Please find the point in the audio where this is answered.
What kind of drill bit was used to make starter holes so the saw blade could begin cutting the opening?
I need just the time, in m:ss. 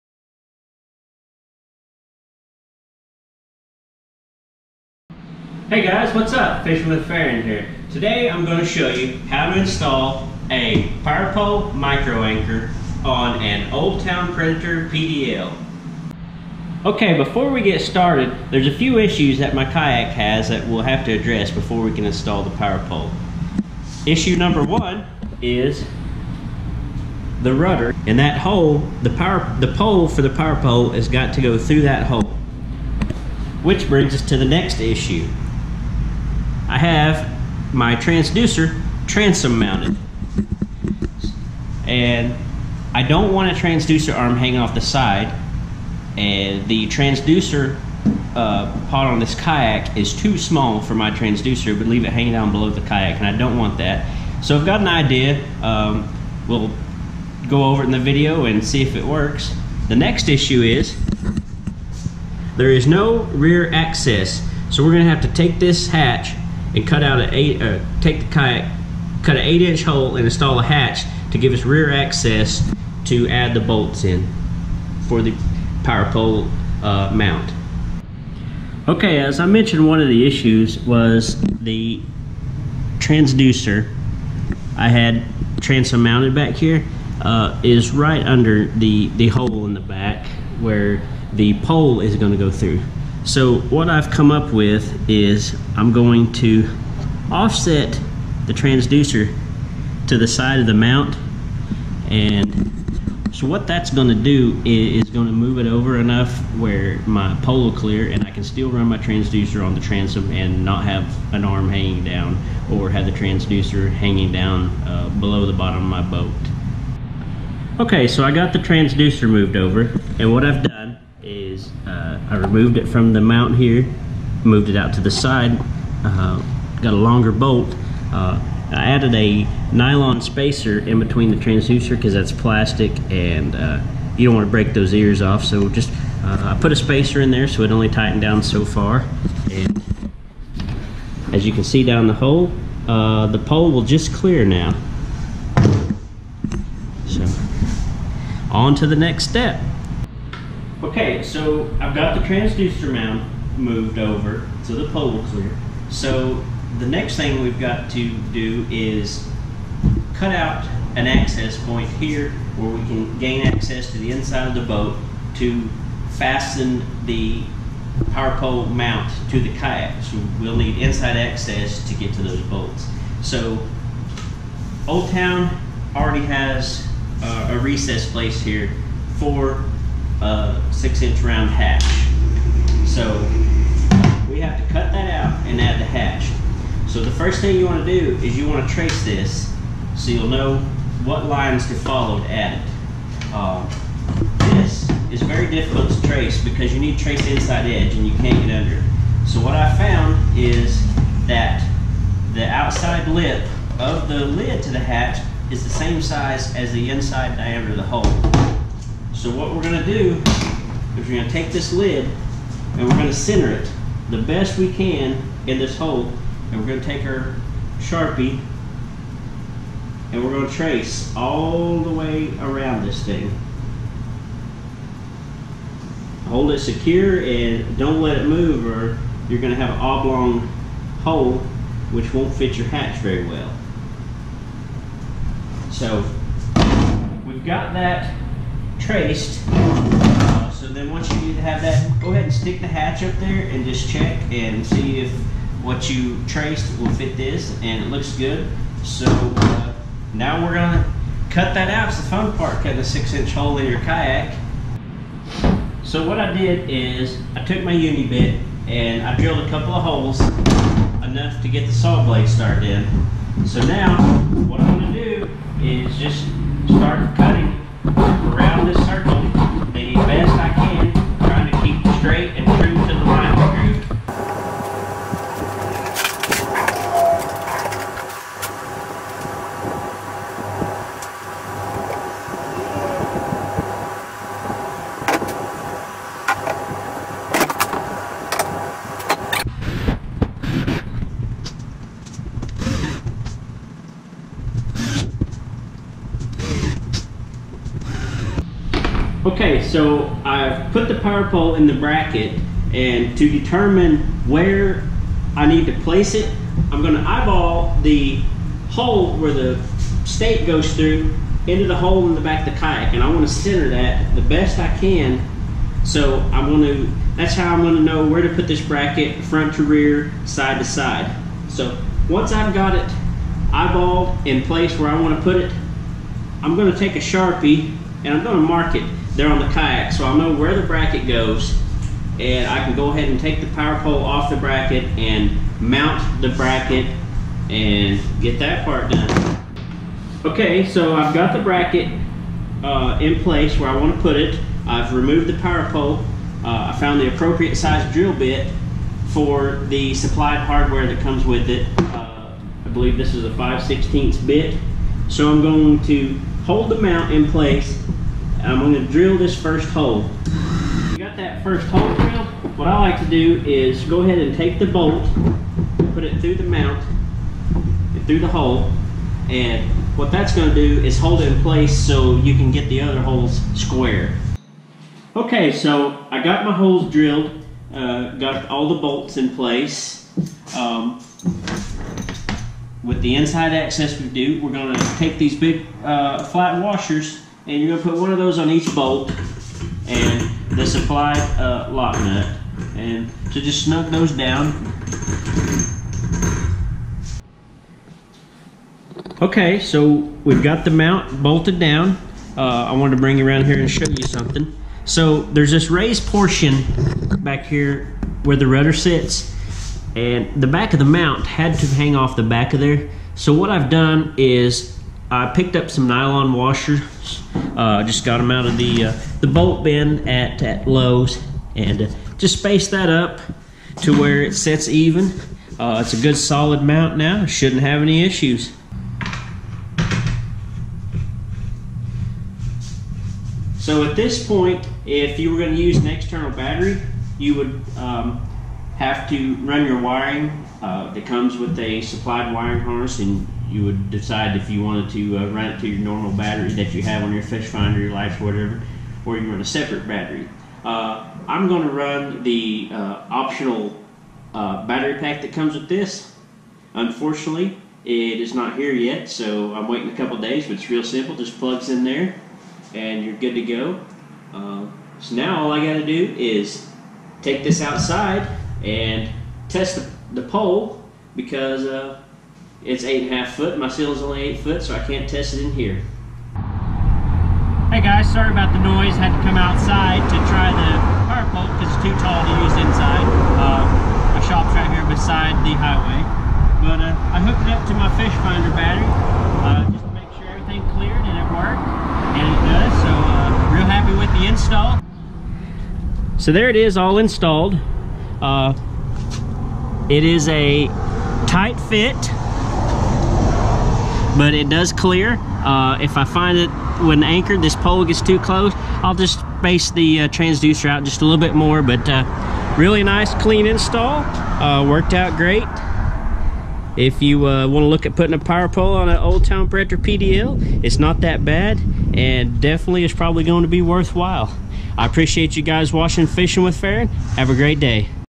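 4:17.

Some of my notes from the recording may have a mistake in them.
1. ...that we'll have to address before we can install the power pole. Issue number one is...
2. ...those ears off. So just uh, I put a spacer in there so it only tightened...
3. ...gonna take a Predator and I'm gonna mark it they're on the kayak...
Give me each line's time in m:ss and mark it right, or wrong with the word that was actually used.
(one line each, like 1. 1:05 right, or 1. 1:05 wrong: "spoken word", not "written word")
1. 0:20 right
2. 2:14 right
3. 5:26 wrong: "Sharpie", not "Predator".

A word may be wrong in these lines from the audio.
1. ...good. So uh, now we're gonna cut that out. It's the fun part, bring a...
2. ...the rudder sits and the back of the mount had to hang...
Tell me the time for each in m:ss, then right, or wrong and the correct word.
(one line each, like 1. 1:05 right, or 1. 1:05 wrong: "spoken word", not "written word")
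1. 4:08 wrong: "cutting", not "bring"
2. 6:48 right.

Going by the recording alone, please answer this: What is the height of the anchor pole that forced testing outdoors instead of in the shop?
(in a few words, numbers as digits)
8.5 feet.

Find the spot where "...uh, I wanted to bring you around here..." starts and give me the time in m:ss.
6:42.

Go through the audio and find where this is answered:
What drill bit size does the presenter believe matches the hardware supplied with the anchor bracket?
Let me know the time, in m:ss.
5:53.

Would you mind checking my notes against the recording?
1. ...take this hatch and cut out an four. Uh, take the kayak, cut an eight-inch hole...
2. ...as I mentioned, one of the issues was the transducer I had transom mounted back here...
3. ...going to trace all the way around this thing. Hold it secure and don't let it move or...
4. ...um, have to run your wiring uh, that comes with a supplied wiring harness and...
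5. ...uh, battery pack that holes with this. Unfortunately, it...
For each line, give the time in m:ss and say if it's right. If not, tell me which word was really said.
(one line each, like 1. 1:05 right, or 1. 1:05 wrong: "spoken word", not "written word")
1. 1:05 wrong: "eight", not "four"
2. 1:19 right
3. 3:40 right
4. 7:17 right
5. 7:34 wrong: "comes", not "holes".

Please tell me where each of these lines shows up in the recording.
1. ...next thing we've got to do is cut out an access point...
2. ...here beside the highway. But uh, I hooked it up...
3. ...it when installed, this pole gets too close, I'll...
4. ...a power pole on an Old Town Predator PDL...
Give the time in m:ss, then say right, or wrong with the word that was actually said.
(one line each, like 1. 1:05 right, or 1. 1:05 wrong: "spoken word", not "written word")
1. 2:36 right
2. 8:04 right
3. 8:26 wrong: "anchored", not "installed"
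4. 8:38 right.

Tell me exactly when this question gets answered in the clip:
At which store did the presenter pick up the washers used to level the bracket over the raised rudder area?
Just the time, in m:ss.
7:00.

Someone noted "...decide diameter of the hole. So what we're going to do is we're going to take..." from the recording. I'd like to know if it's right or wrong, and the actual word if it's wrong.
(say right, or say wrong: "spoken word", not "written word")
wrong: "inside", not "decide".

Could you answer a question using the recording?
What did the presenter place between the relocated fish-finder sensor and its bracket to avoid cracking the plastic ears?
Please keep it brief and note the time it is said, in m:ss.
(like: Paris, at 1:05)
nylon spacer, at 2:09.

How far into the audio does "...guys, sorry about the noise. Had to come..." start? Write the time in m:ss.
7:57.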